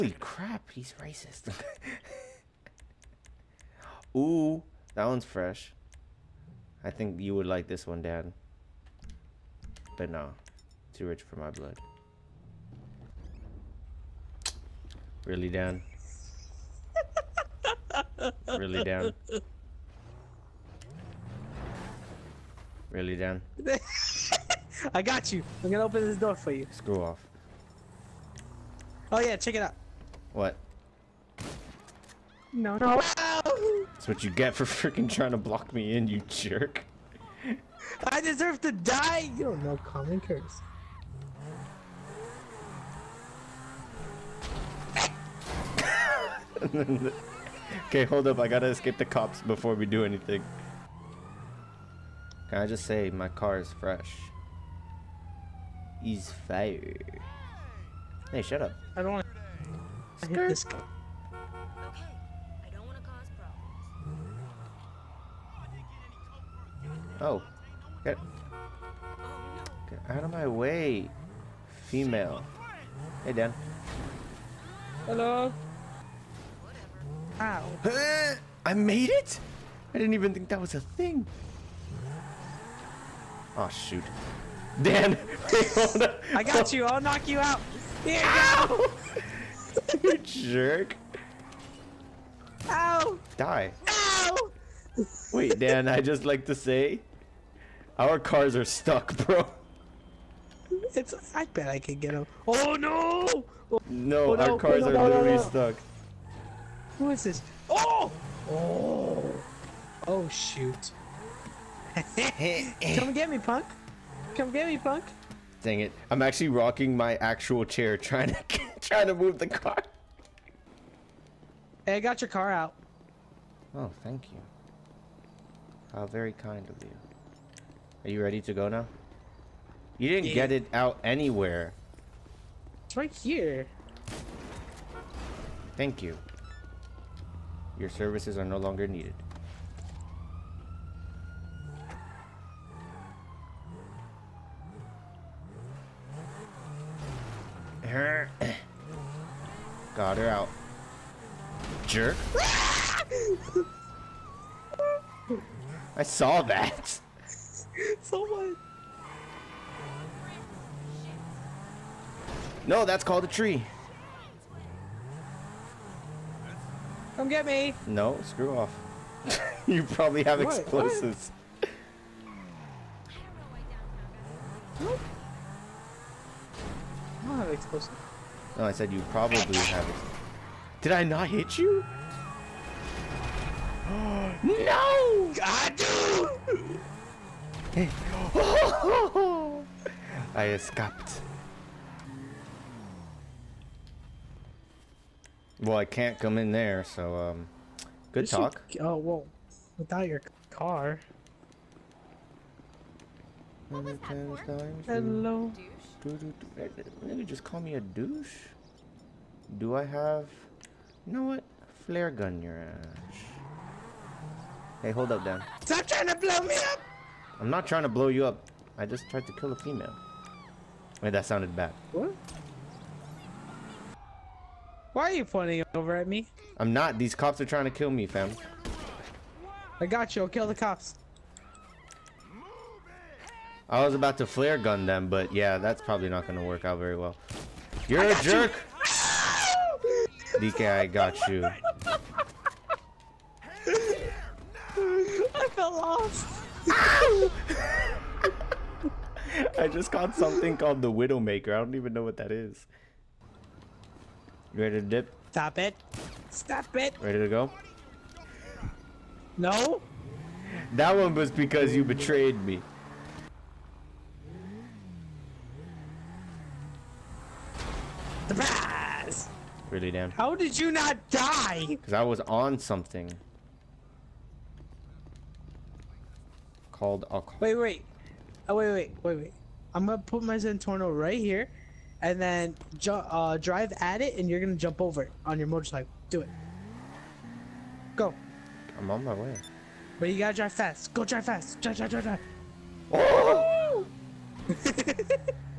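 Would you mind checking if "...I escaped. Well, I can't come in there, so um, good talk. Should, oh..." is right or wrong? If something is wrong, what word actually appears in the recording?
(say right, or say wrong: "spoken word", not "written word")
right.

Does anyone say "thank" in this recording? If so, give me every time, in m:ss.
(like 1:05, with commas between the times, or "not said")
2:04, 2:15.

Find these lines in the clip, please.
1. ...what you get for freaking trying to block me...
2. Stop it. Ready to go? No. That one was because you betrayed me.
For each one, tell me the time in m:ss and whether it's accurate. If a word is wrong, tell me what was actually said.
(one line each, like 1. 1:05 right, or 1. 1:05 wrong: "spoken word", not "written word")
1. 0:34 right
2. 4:16 right.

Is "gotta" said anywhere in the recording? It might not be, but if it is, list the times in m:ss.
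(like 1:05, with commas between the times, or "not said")
0:48, 4:50.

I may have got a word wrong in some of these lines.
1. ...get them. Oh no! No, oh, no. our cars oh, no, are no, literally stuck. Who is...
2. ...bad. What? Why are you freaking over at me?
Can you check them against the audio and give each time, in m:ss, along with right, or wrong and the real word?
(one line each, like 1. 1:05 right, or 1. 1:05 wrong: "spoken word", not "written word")
1. 1:41 right
2. 3:41 wrong: "pointing", not "freaking".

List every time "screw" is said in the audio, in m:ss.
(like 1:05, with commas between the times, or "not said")
0:26, 2:48.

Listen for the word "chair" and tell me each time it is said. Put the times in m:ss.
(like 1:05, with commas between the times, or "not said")
1:57.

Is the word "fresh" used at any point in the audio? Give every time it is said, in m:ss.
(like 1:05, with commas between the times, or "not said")
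0:05, 0:53.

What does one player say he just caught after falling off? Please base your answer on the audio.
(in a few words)
Widowmaker.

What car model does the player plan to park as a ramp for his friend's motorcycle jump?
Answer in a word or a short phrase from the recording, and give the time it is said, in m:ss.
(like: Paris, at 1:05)
Zentorno, at 4:40.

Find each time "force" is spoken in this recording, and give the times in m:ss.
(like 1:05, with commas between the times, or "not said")
not said.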